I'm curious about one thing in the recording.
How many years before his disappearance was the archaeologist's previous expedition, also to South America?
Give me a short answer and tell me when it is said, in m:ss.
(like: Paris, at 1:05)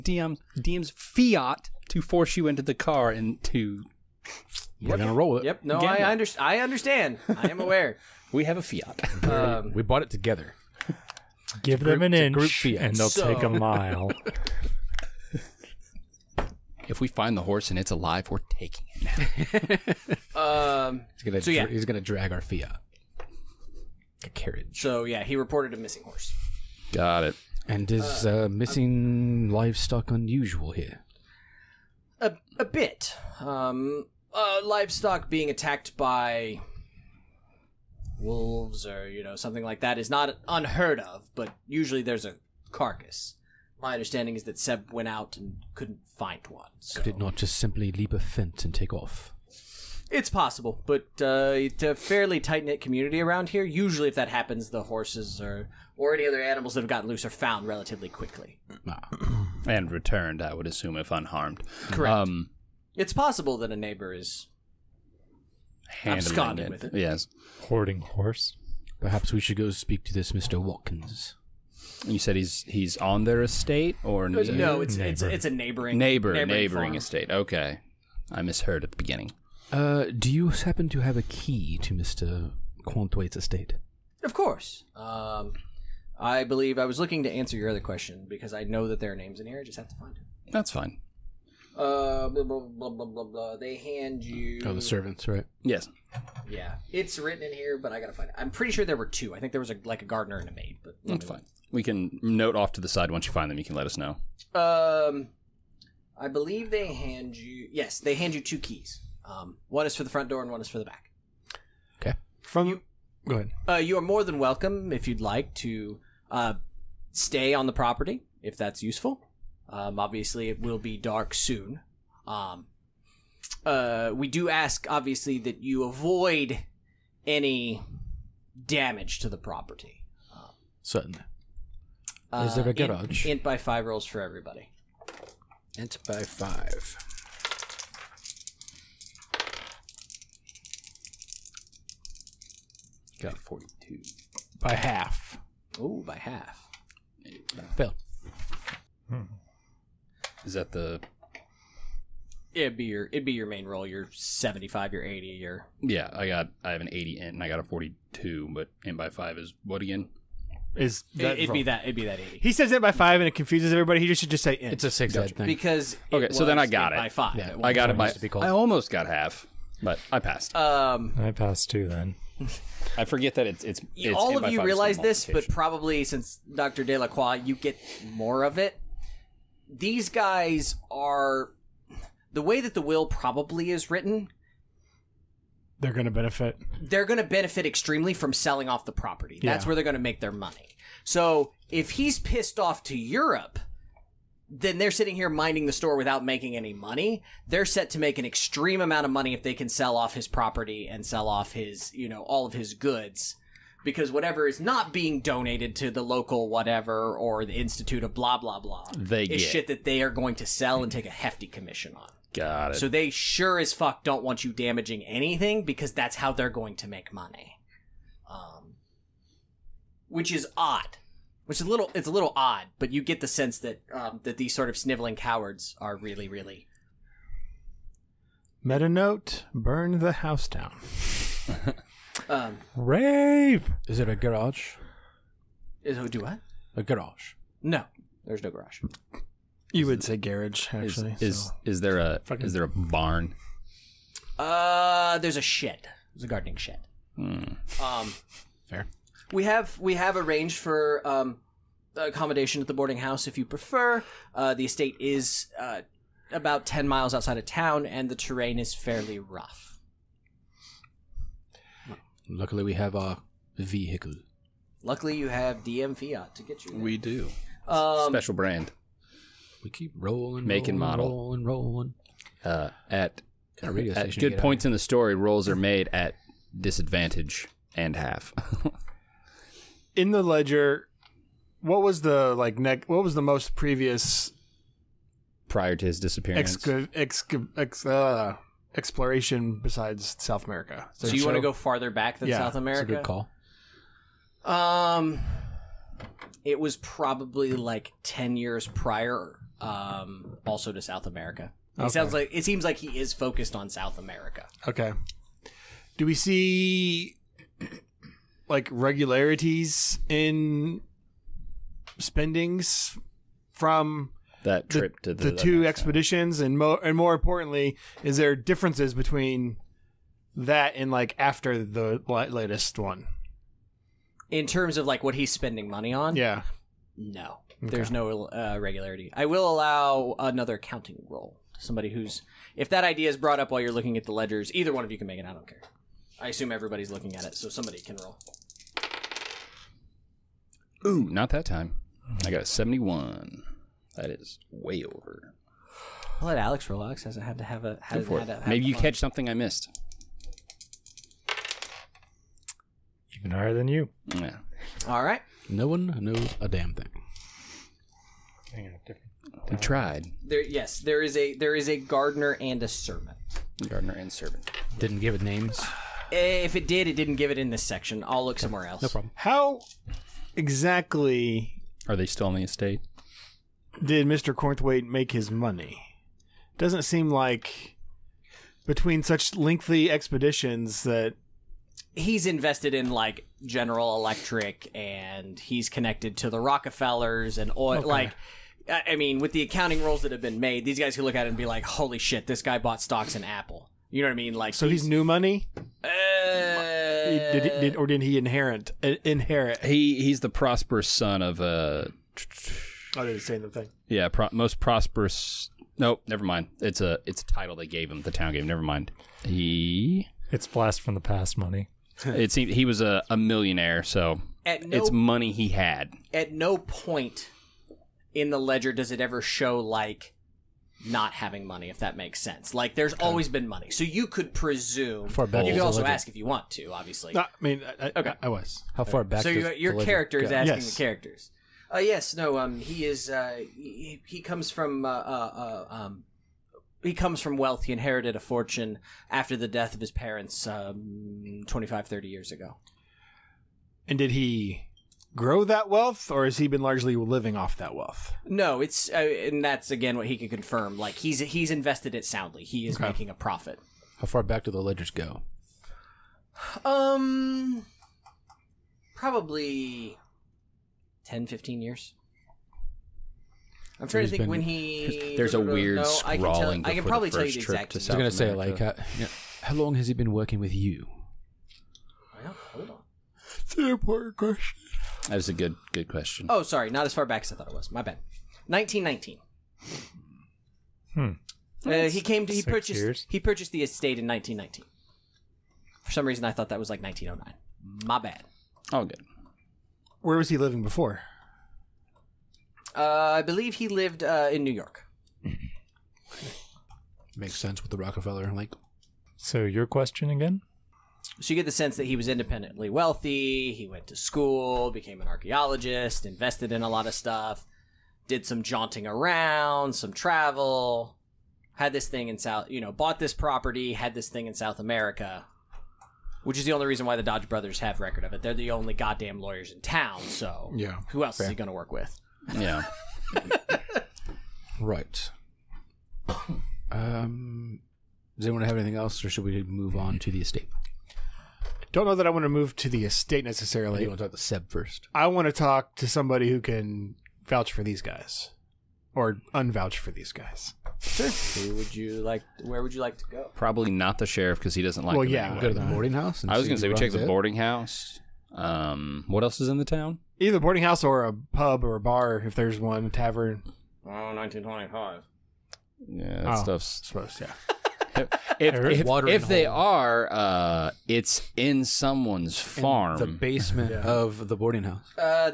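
10 years, at 4:58.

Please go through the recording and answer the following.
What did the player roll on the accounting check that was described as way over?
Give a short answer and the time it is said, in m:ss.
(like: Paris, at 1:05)
71, at 5:42.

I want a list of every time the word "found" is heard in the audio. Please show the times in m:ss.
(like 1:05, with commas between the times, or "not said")
0:57.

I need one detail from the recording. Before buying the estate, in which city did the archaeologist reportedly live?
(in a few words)
New York.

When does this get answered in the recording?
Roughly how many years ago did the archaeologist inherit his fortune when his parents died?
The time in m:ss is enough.
7:21.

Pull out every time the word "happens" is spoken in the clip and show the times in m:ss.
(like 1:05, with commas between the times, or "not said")
0:54, 1:20.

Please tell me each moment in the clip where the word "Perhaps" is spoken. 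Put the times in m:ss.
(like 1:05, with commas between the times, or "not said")
1:09.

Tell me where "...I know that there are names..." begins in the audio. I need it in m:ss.
1:28.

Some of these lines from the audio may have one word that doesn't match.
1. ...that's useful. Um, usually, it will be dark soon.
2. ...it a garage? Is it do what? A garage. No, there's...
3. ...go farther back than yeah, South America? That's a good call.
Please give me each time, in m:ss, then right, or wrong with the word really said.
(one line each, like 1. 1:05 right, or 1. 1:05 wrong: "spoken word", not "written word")
1. 1:58 wrong: "obviously", not "usually"
2. 3:53 right
3. 4:51 right.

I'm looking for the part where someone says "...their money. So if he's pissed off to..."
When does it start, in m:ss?
3:10.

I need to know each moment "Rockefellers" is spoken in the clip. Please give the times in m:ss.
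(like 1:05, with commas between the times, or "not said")
6:26, 8:17.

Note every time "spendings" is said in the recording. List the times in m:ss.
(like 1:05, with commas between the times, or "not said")
5:11, 5:25.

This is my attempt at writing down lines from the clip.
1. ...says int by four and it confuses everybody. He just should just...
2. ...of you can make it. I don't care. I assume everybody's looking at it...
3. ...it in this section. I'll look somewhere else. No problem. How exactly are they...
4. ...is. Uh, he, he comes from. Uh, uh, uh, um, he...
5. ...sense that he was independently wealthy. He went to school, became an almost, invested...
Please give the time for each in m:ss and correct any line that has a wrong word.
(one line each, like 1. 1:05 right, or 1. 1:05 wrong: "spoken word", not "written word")
1. 2:42 wrong: "five", not "four"
2. 5:34 right
3. 6:07 right
4. 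7:12 right
5. 8:21 wrong: "archaeologist", not "almost".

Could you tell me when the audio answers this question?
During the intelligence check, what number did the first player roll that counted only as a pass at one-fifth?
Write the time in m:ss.
2:23.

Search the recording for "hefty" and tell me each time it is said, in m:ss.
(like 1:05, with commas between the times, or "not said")
3:31.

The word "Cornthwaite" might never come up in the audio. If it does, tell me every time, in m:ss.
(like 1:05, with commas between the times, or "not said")
1:22, 6:14.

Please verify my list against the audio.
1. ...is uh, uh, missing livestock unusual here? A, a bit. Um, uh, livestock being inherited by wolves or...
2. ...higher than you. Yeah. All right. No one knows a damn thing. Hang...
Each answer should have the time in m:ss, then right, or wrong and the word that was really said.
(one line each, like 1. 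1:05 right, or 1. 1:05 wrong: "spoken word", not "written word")
1. 0:27 wrong: "attacked", not "inherited"
2. 5:53 right.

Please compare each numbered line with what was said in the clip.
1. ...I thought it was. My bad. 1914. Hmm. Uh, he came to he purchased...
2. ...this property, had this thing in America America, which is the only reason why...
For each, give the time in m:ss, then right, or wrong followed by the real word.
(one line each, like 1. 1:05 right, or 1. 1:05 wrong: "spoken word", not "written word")
1. 7:57 wrong: "1919", not "1914"
2. 8:32 wrong: "South", not "America".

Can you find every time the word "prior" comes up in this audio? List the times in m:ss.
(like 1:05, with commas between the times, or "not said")
4:45, 4:58.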